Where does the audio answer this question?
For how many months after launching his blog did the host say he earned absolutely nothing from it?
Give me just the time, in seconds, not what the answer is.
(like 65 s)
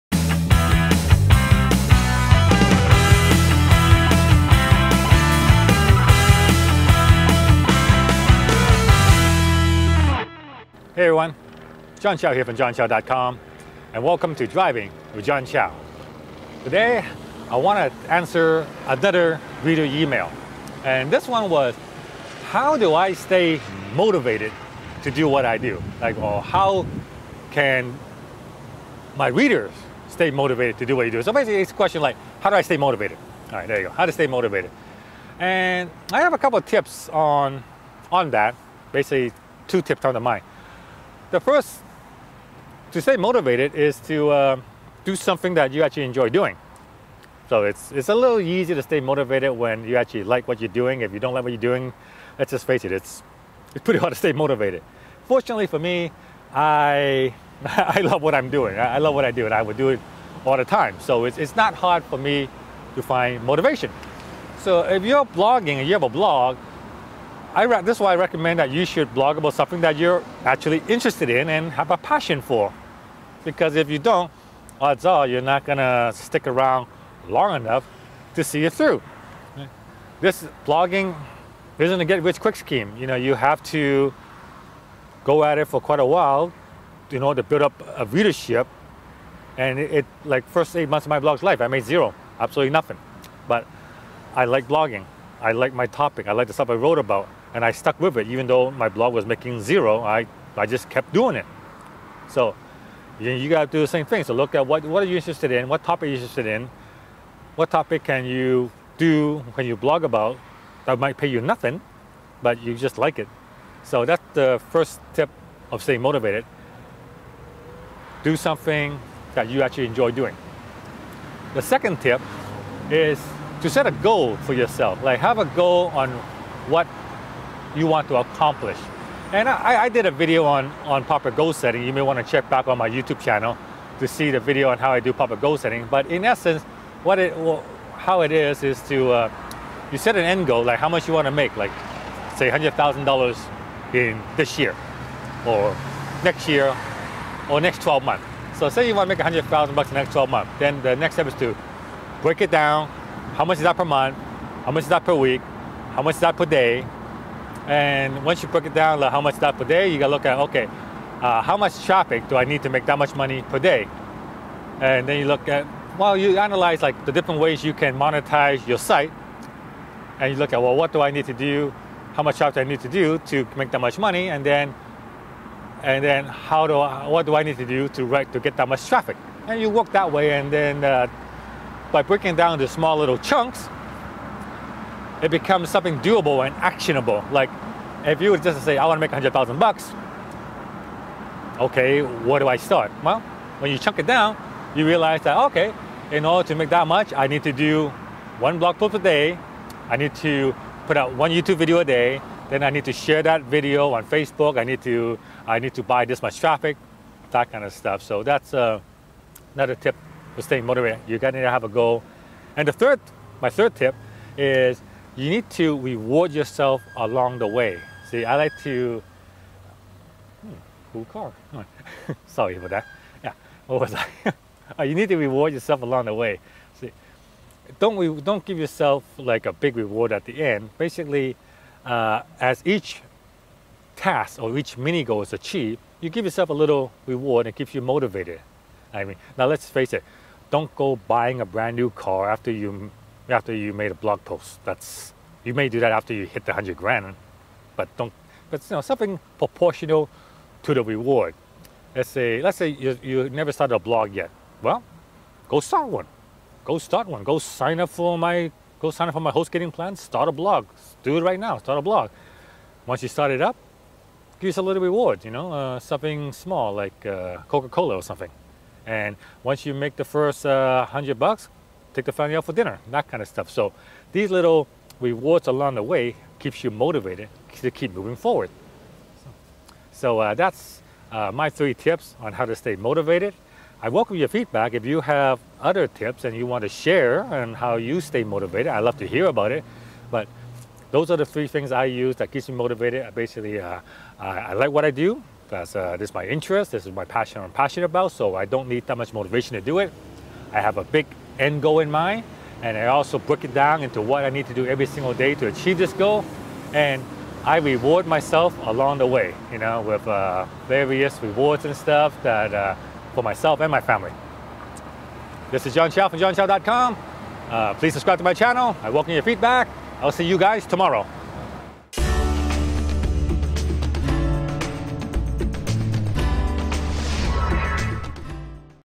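90 s.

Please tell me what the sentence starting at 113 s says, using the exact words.
So that's the first tip of staying motivated.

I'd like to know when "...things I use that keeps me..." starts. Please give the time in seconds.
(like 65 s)
291 s.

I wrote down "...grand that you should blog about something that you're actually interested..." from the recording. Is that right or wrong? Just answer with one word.
wrong.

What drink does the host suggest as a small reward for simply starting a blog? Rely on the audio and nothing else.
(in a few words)
Coca Cola.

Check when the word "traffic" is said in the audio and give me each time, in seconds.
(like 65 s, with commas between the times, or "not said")
161 s, 172 s, 178 s, 206 s.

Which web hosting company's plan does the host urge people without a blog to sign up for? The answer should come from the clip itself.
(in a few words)
HostGator.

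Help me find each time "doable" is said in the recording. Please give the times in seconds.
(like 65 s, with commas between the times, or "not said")
185 s.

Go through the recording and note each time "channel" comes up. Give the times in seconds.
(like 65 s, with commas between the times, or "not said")
133 s, 318 s.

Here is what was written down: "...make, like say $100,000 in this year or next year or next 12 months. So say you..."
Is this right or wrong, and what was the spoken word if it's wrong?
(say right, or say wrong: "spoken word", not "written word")
right.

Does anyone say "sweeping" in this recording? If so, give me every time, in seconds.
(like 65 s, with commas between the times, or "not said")
not said.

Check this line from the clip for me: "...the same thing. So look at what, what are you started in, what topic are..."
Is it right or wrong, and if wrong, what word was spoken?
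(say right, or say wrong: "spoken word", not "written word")
wrong: "interested", not "started".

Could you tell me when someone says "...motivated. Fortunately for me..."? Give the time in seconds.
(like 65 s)
54 s.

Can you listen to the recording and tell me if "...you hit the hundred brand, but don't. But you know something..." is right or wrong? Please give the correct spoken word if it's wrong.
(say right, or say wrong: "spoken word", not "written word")
wrong: "grand", not "brand".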